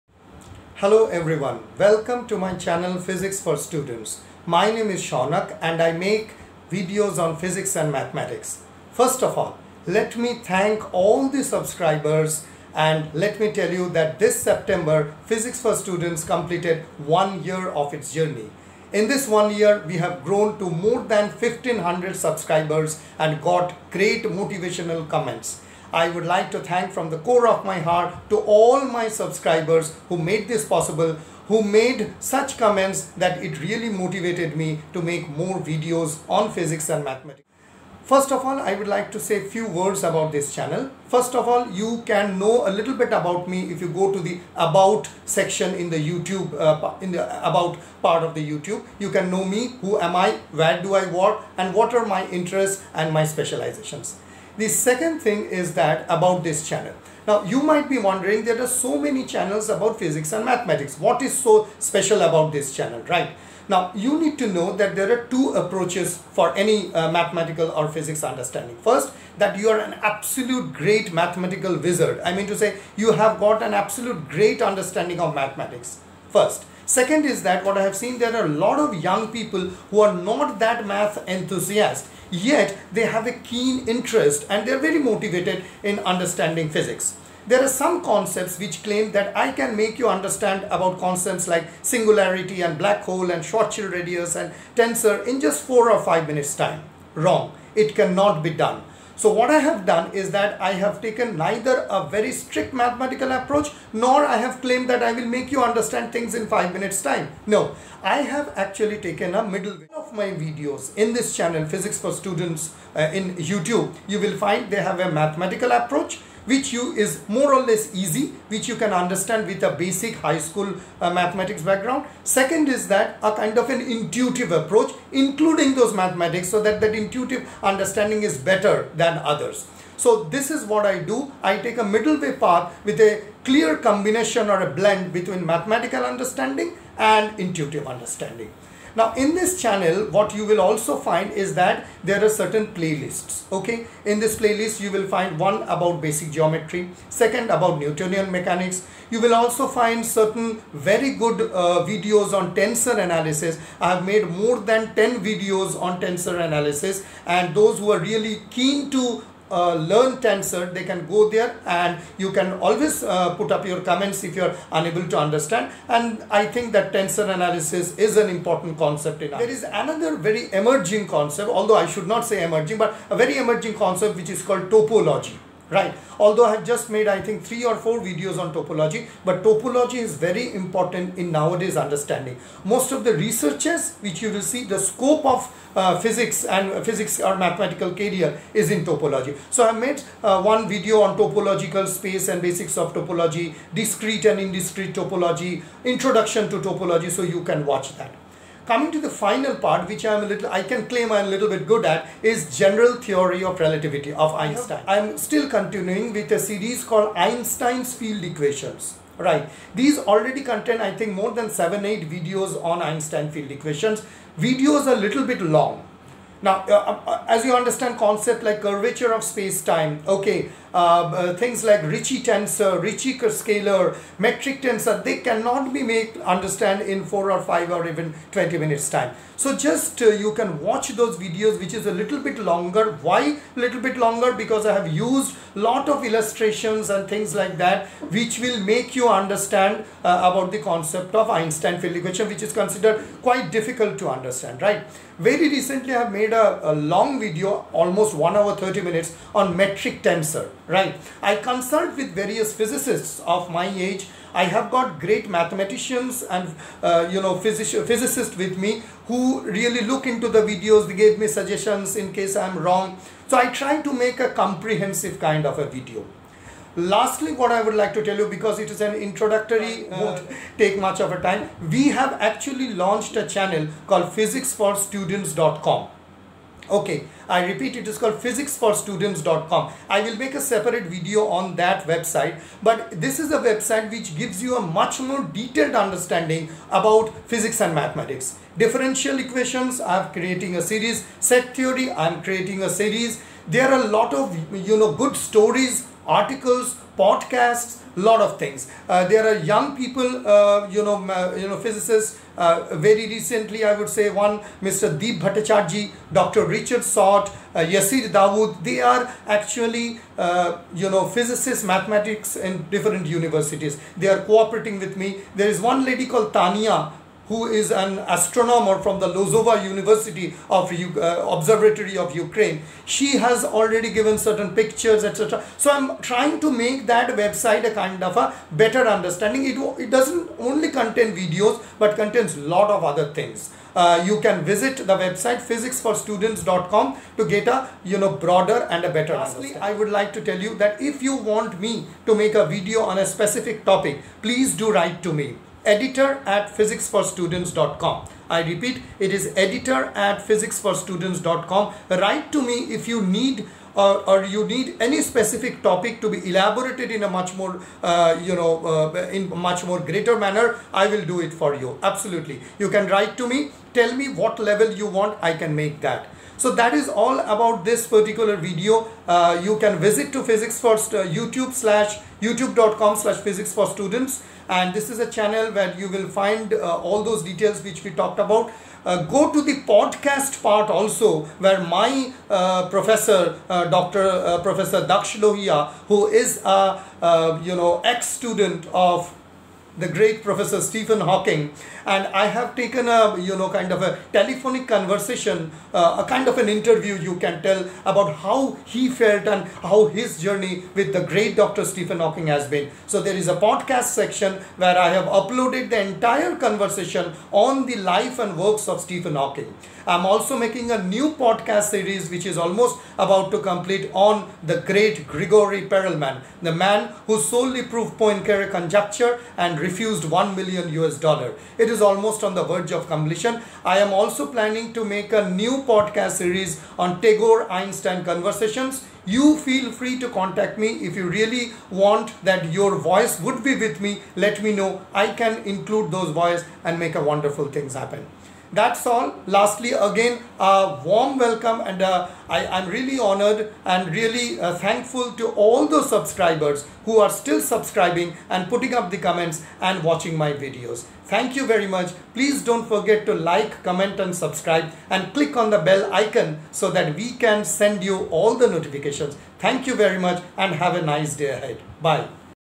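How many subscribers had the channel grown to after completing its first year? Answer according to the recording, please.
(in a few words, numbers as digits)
more than 1500.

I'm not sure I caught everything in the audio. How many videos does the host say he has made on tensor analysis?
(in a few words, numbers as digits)
more than 10.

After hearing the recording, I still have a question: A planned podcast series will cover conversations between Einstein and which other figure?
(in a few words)
Tagore.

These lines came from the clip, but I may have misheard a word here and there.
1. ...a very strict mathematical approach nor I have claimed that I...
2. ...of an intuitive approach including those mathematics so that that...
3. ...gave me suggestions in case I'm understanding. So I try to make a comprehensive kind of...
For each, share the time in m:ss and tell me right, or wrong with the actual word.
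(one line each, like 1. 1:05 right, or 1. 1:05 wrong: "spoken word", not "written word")
1. 1:41 right
2. 2:03 right
3. 4:21 wrong: "wrong", not "understanding".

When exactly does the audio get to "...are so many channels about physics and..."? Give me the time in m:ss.
0:58.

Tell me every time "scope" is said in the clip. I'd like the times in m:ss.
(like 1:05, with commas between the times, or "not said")
3:04.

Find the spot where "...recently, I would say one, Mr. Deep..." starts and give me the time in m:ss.
5:03.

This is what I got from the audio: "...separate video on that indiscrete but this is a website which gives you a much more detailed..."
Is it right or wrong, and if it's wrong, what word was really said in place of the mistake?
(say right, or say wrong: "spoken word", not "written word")
wrong: "website", not "indiscrete".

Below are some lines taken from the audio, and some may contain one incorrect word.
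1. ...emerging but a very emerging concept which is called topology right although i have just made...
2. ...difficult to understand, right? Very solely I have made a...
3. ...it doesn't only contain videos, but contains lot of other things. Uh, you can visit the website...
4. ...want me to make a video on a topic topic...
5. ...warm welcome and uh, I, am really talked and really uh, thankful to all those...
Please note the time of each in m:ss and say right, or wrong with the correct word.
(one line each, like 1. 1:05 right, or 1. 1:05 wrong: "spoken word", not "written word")
1. 2:52 right
2. 4:03 wrong: "recently", not "solely"
3. 5:29 right
4. 5:41 wrong: "specific", not "topic"
5. 7:20 wrong: "honored", not "talked".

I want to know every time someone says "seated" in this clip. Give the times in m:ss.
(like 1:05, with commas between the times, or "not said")
not said.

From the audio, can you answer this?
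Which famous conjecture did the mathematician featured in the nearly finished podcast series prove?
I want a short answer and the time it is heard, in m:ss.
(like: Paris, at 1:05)
Poincare conjecture, at 6:57.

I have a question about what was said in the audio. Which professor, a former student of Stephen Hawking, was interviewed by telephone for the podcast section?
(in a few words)
Daksh Lohiya.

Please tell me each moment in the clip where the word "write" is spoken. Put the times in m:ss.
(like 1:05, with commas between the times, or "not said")
5:44, 5:51, 6:02.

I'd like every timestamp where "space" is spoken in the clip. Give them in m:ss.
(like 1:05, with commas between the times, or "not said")
3:11, 3:39.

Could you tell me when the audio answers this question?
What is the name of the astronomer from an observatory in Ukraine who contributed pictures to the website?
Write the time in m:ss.
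5:16.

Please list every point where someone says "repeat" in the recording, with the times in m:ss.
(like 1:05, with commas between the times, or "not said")
4:37, 5:48.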